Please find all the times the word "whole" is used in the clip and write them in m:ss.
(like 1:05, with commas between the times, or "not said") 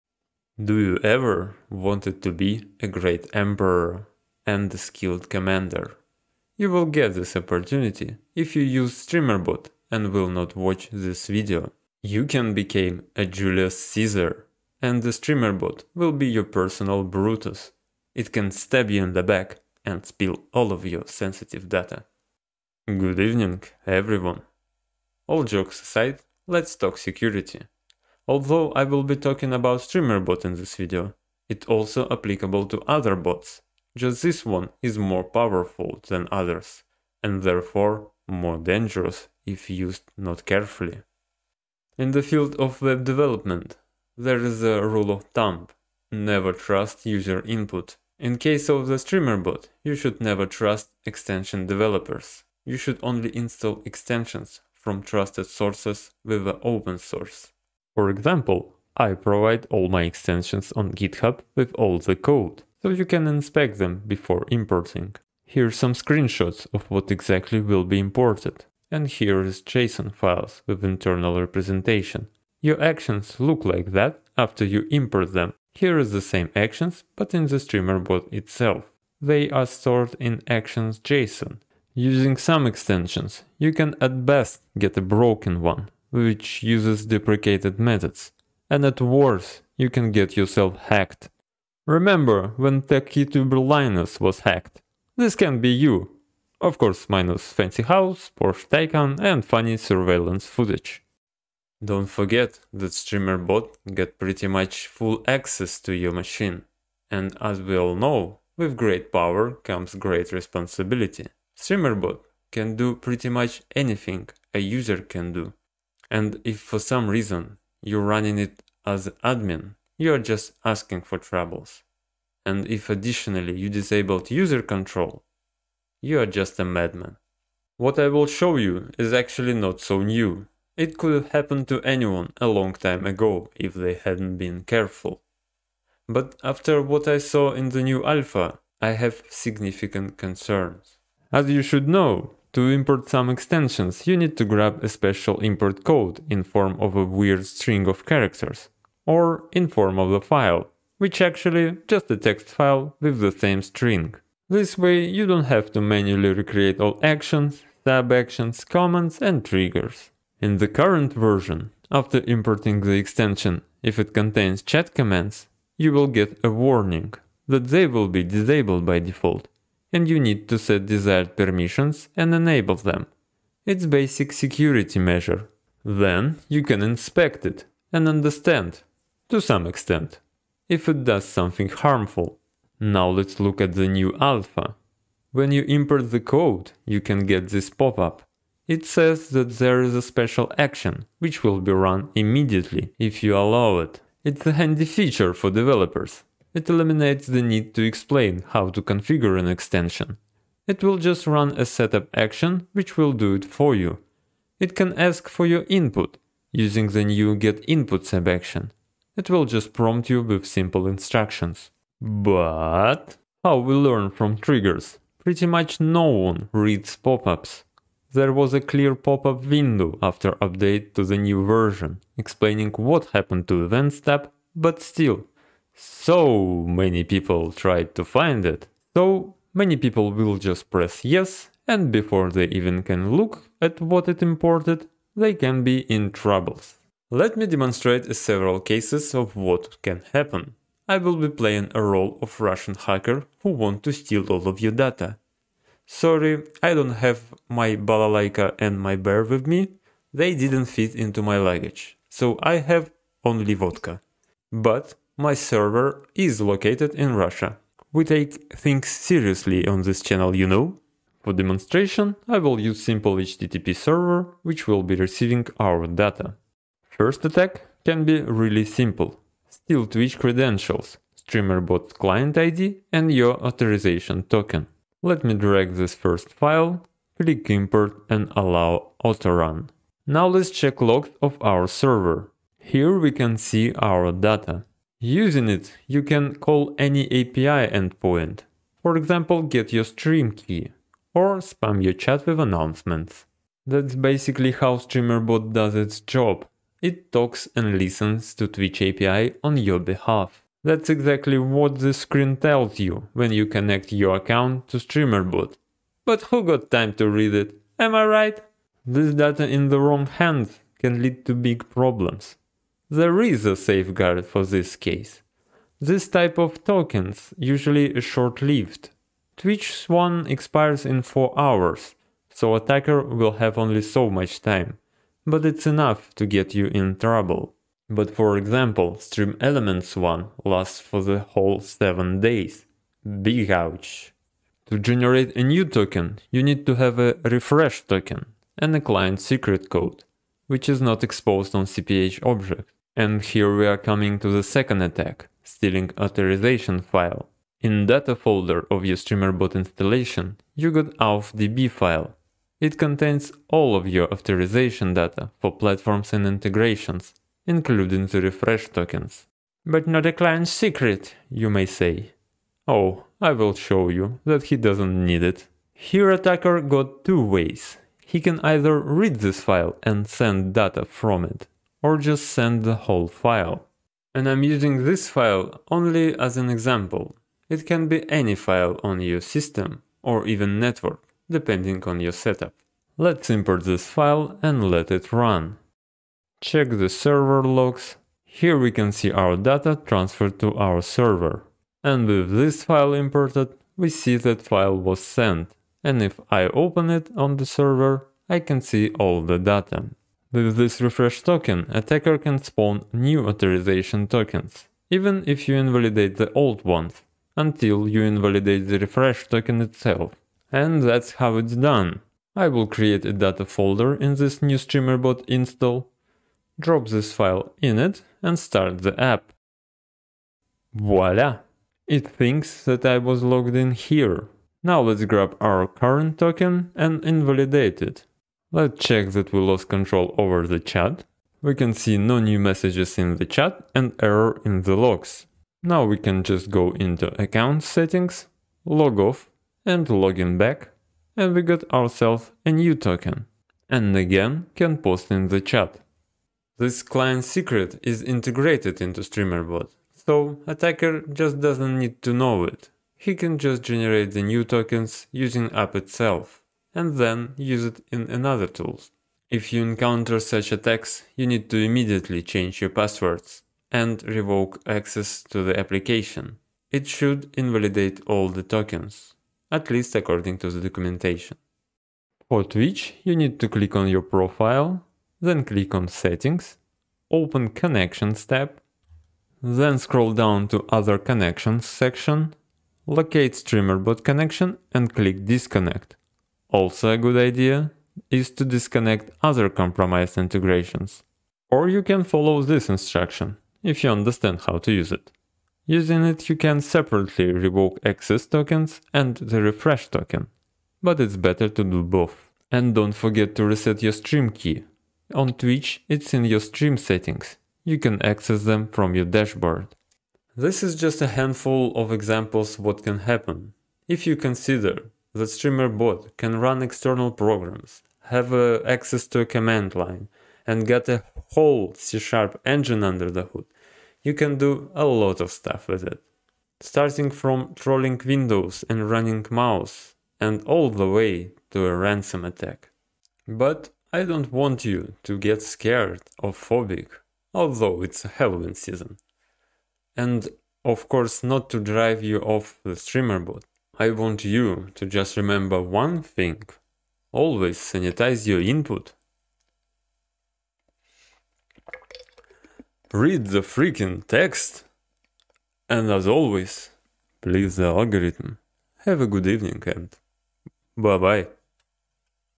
5:31, 6:12, 8:41.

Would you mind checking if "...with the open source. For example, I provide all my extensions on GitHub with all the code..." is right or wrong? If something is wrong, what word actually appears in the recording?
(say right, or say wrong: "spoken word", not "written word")
right.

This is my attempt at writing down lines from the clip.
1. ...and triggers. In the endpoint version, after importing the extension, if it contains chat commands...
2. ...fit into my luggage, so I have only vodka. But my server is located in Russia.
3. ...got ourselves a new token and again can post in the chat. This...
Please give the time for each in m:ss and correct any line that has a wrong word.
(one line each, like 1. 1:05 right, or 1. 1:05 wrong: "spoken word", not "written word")
1. 2:39 wrong: "current", not "endpoint"
2. 4:10 right
3. 7:21 right.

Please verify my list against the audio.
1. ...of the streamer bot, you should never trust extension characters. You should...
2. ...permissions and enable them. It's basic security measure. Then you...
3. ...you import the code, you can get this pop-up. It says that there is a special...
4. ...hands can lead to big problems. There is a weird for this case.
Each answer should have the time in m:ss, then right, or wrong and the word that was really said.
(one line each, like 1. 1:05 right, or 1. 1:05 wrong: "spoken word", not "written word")
1. 0:48 wrong: "developers", not "characters"
2. 2:51 right
3. 3:05 right
4. 5:10 wrong: "safeguard", not "weird".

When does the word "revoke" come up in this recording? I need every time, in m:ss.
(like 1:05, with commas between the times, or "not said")
7:44, 8:17.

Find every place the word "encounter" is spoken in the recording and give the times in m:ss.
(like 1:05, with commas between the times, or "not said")
7:39.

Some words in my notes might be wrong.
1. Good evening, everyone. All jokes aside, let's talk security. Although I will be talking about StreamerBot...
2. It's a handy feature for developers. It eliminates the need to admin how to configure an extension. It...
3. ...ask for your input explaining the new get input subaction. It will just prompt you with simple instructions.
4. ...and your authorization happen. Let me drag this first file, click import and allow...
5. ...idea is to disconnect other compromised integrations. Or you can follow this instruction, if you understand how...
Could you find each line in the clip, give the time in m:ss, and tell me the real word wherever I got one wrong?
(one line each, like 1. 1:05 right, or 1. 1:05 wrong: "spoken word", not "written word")
1. 0:22 right
2. 3:14 wrong: "explain", not "admin"
3. 3:24 wrong: "using", not "explaining"
4. 4:32 wrong: "token", not "happen"
5. 8:07 right.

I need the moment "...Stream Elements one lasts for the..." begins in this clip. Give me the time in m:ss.
5:28.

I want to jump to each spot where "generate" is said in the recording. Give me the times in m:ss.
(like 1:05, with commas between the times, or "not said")
5:34, 7:33.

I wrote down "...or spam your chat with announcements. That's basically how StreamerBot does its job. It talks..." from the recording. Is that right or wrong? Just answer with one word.
right.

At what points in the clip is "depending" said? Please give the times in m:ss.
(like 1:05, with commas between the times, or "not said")
6:21.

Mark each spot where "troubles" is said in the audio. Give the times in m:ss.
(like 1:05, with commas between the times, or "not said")
2:01, 3:56, 5:26.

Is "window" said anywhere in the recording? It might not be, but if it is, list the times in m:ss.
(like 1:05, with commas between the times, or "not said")
3:39, 8:48.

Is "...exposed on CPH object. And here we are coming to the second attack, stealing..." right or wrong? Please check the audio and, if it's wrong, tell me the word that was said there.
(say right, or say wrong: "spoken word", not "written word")
right.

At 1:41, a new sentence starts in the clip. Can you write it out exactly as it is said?
Don't forget that StreamerBot get pretty much full access to your machine.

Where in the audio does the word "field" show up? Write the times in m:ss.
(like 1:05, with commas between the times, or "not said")
0:42.